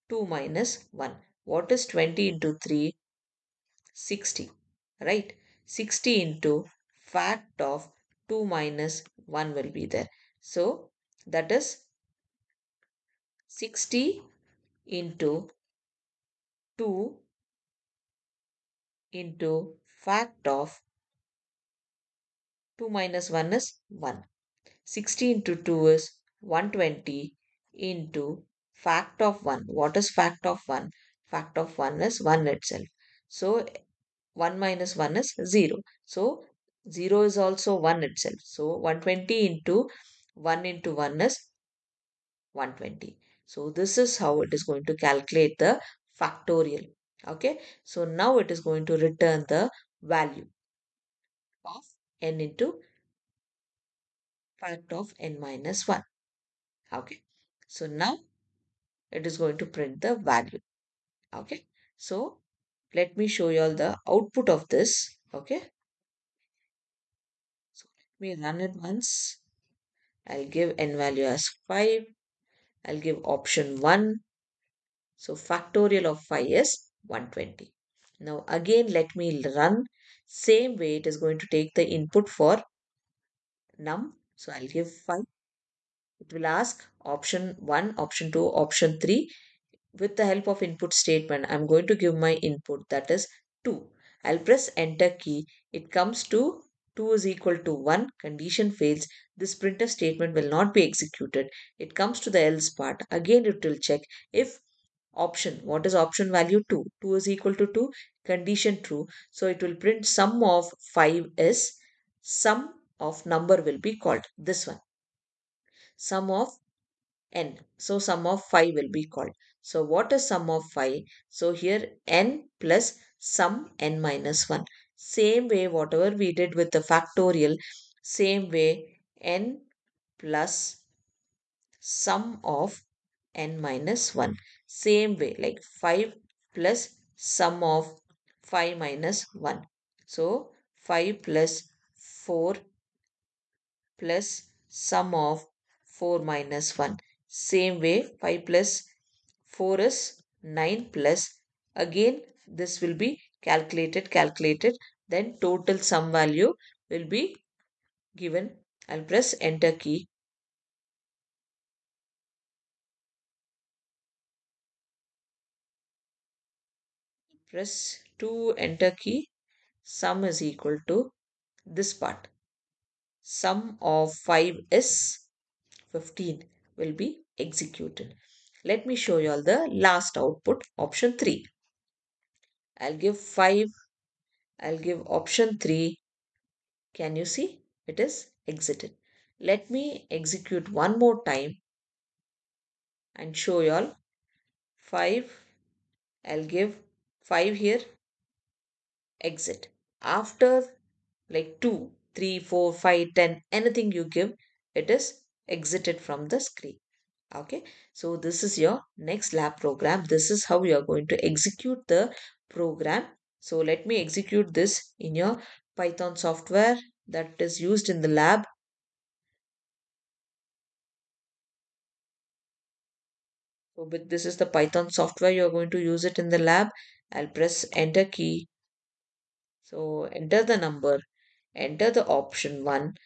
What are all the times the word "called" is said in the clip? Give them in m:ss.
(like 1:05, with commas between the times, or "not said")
1:53, 1:59.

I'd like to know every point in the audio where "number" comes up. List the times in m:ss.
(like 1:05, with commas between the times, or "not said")
1:53, 3:50.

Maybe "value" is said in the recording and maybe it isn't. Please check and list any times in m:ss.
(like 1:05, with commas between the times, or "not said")
0:50, 1:00, 1:11, 1:46, 2:36.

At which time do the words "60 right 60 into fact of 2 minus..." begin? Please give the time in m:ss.
0:03.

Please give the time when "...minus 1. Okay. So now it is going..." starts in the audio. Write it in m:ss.
0:55.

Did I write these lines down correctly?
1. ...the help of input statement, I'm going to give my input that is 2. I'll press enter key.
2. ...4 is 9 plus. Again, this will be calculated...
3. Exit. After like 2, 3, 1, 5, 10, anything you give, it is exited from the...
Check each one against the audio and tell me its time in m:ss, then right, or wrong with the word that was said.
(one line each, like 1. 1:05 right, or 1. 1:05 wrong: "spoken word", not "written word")
1. 1:30 right
2. 2:29 right
3. 3:19 wrong: "4", not "1".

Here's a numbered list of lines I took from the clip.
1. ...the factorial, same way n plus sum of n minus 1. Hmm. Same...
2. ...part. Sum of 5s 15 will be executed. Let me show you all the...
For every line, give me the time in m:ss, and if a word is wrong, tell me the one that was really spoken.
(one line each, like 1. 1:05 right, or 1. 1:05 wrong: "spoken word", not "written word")
1. 2:06 right
2. 2:51 right.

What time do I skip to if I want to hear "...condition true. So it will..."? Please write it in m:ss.
1:48.